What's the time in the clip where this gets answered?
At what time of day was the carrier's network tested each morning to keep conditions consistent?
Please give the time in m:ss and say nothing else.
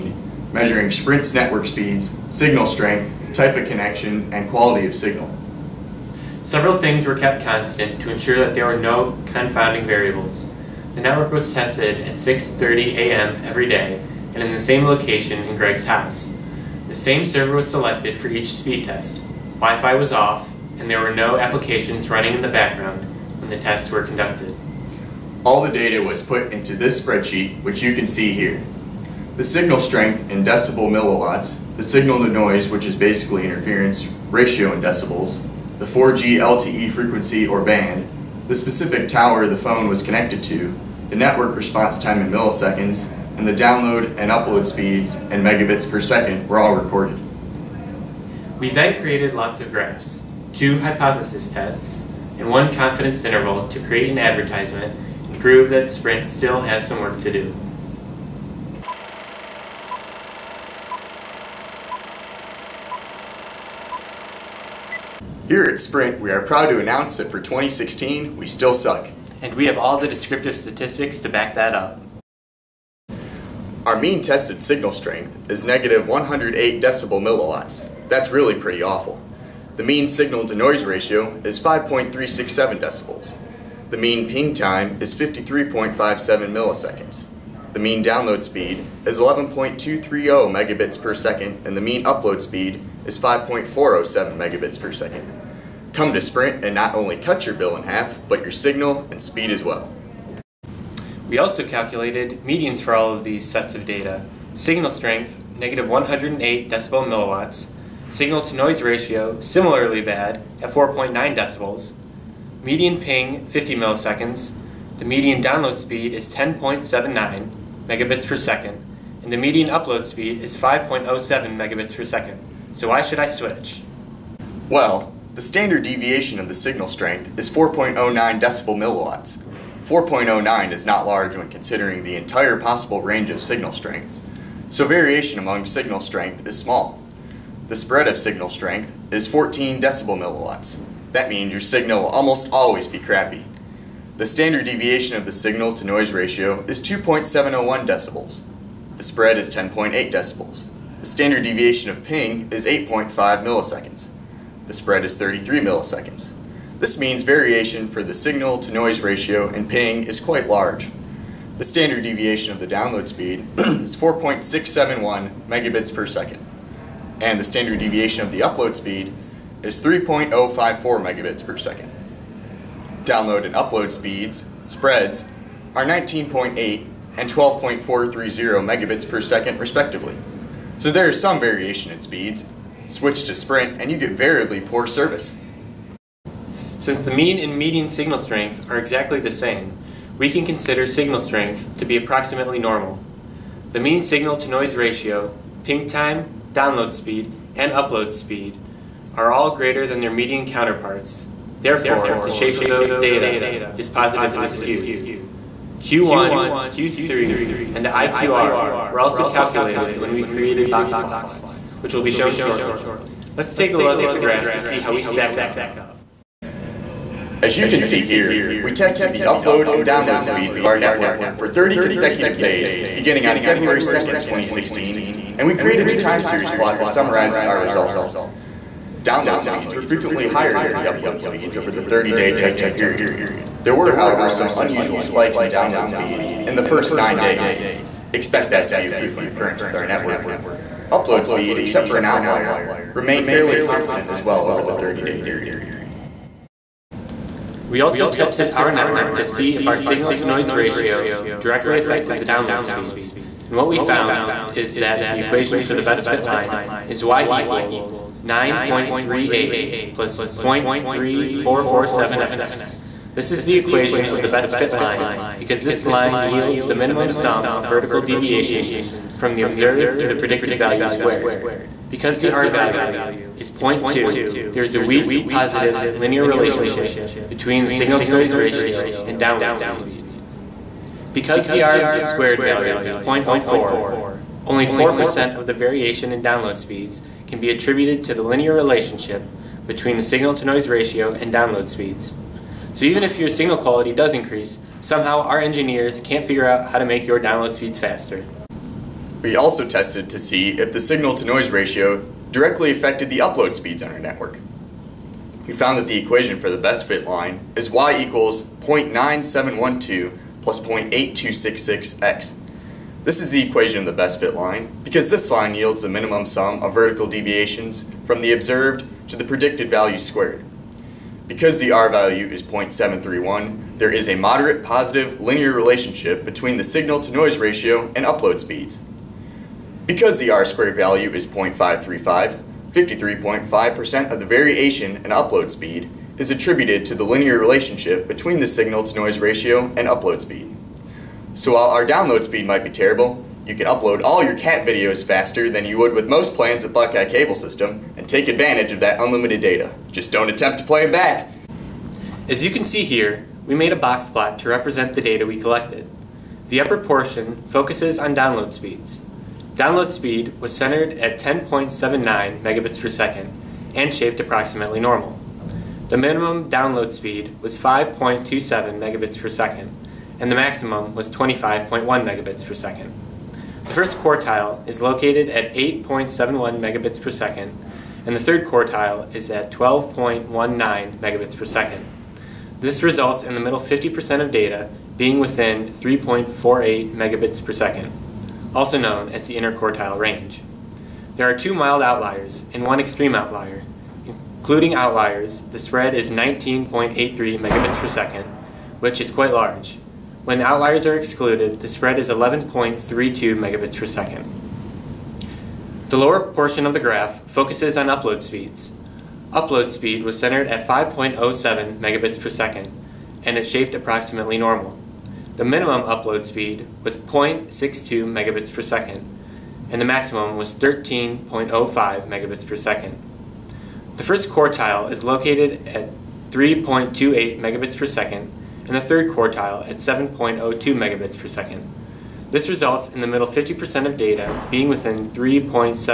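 0:12.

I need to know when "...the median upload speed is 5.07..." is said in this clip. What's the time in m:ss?
1:59.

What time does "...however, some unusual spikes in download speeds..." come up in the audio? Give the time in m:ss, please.
3:53.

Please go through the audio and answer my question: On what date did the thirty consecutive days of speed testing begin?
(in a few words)
February 2nd, 2016.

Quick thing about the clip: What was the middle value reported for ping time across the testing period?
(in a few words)
50 milliseconds.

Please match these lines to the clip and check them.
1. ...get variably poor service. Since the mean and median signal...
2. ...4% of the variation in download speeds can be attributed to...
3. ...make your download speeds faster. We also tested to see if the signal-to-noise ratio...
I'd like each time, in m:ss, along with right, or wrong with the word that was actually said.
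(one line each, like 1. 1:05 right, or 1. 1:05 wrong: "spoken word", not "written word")
1. 3:03 right
2. 4:44 right
3. 4:56 right.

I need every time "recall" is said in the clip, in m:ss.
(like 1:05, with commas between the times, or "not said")
not said.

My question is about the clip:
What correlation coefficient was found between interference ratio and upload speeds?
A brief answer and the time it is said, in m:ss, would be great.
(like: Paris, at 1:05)
0.731, at 5:22.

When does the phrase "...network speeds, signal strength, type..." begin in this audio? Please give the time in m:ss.
0:01.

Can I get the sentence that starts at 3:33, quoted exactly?
Let's take a look at the graphs to see how we stack up.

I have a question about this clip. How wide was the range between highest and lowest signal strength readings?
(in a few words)
14 decibel milliwatts.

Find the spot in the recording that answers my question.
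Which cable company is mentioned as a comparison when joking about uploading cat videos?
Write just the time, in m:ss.
5:46.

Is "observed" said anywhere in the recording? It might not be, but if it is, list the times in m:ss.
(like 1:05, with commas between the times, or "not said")
4:29, 5:18.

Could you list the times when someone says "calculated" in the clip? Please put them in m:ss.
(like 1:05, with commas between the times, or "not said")
1:41, 3:29.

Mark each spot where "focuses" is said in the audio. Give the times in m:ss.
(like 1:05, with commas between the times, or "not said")
5:57, 6:47.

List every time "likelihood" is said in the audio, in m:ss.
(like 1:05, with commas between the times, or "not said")
not said.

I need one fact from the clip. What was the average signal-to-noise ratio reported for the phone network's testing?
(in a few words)
5.367 decibels.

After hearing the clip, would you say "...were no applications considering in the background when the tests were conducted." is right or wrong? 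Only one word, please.
wrong.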